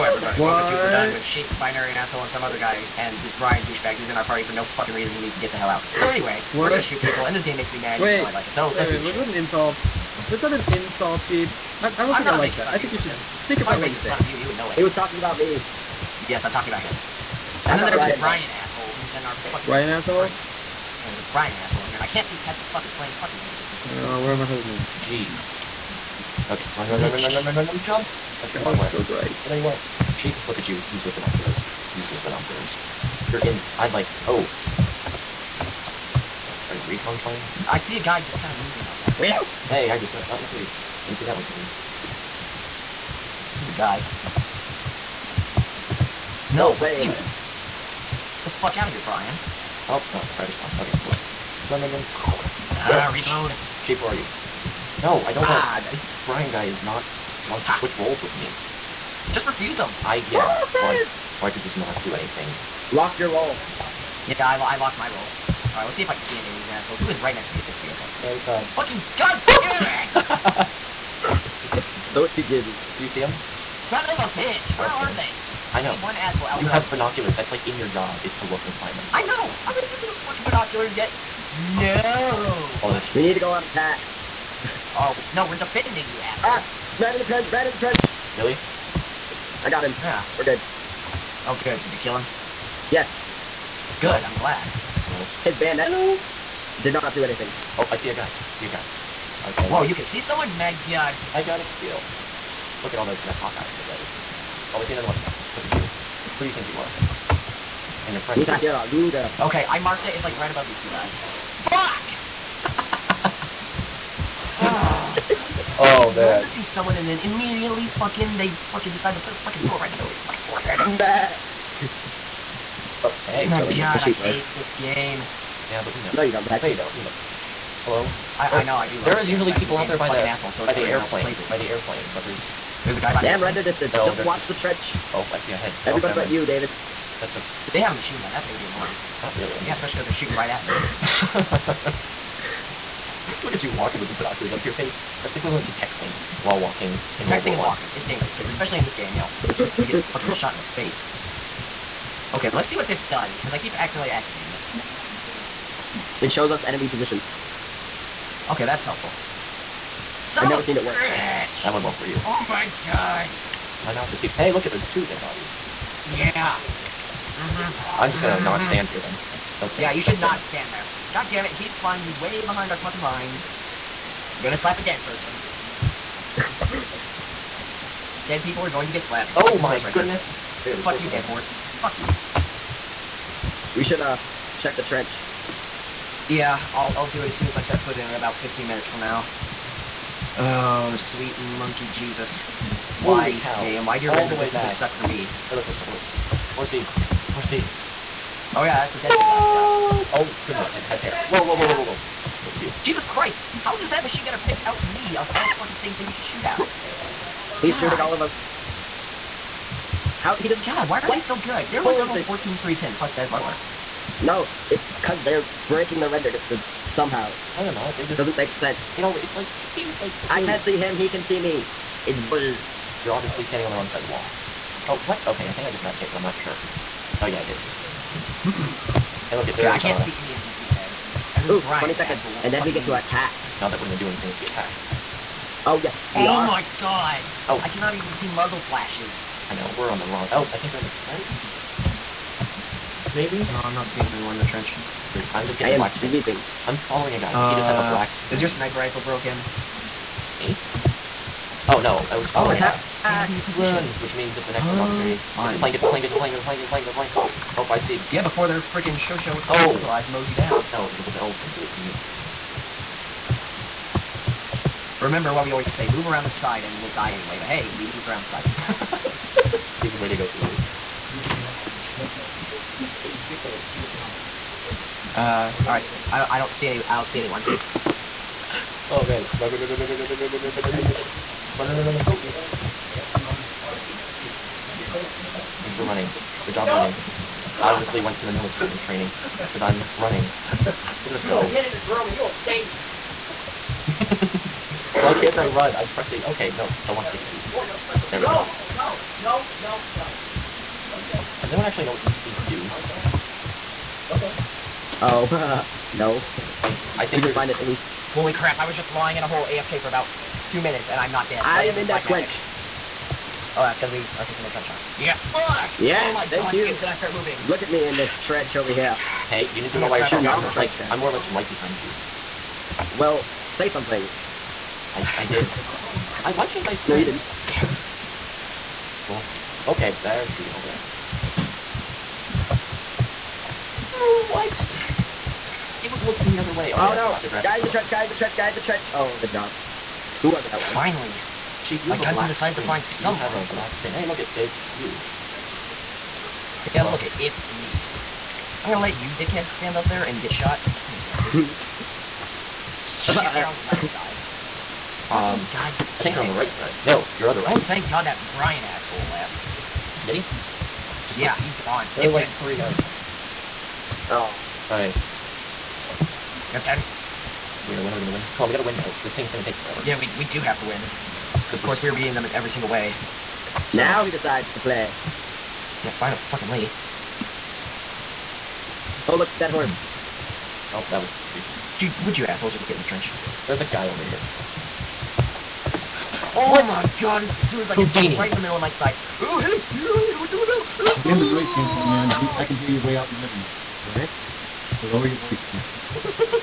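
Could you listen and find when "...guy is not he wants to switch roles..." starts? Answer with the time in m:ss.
0:56.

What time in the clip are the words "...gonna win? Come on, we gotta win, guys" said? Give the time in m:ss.
6:07.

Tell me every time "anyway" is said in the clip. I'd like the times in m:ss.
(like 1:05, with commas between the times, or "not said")
0:06, 4:27.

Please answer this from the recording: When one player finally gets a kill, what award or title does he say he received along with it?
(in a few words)
Hawkeye.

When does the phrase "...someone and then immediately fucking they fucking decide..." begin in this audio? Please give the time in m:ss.
1:56.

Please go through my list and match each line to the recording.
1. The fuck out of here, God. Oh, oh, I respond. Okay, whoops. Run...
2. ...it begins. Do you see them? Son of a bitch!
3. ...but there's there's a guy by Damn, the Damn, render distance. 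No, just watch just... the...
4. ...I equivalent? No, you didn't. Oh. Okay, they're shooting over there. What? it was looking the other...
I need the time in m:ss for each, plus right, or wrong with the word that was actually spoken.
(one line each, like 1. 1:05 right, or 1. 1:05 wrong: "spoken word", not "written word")
1. 0:48 wrong: "Brian", not "God"
2. 1:12 right
3. 2:12 right
4. 5:26 wrong: "sprint", not "equivalent".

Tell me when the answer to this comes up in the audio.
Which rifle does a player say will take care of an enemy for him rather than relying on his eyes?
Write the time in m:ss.
4:20.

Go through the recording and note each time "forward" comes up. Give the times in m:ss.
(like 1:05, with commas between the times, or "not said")
not said.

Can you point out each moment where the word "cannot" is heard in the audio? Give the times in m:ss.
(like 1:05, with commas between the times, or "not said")
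3:57.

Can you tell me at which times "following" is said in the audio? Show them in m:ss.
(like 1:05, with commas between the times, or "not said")
4:06, 4:12.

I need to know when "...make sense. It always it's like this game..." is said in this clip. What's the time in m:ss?
3:38.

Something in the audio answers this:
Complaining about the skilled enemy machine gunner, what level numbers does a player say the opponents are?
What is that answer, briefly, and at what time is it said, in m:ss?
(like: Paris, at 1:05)
14, 310, at 3:31.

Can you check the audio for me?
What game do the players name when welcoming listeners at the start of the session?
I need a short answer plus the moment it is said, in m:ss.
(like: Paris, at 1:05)
Verdun, at 0:00.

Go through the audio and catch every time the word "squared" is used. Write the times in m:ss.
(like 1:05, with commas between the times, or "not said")
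not said.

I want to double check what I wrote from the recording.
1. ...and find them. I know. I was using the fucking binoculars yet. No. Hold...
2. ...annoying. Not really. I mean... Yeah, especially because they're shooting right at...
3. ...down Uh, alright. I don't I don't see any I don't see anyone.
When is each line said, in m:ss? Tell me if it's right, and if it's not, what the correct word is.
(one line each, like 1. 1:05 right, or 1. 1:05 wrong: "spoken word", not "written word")
1. 1:18 right
2. 2:18 right
3. 4:33 right.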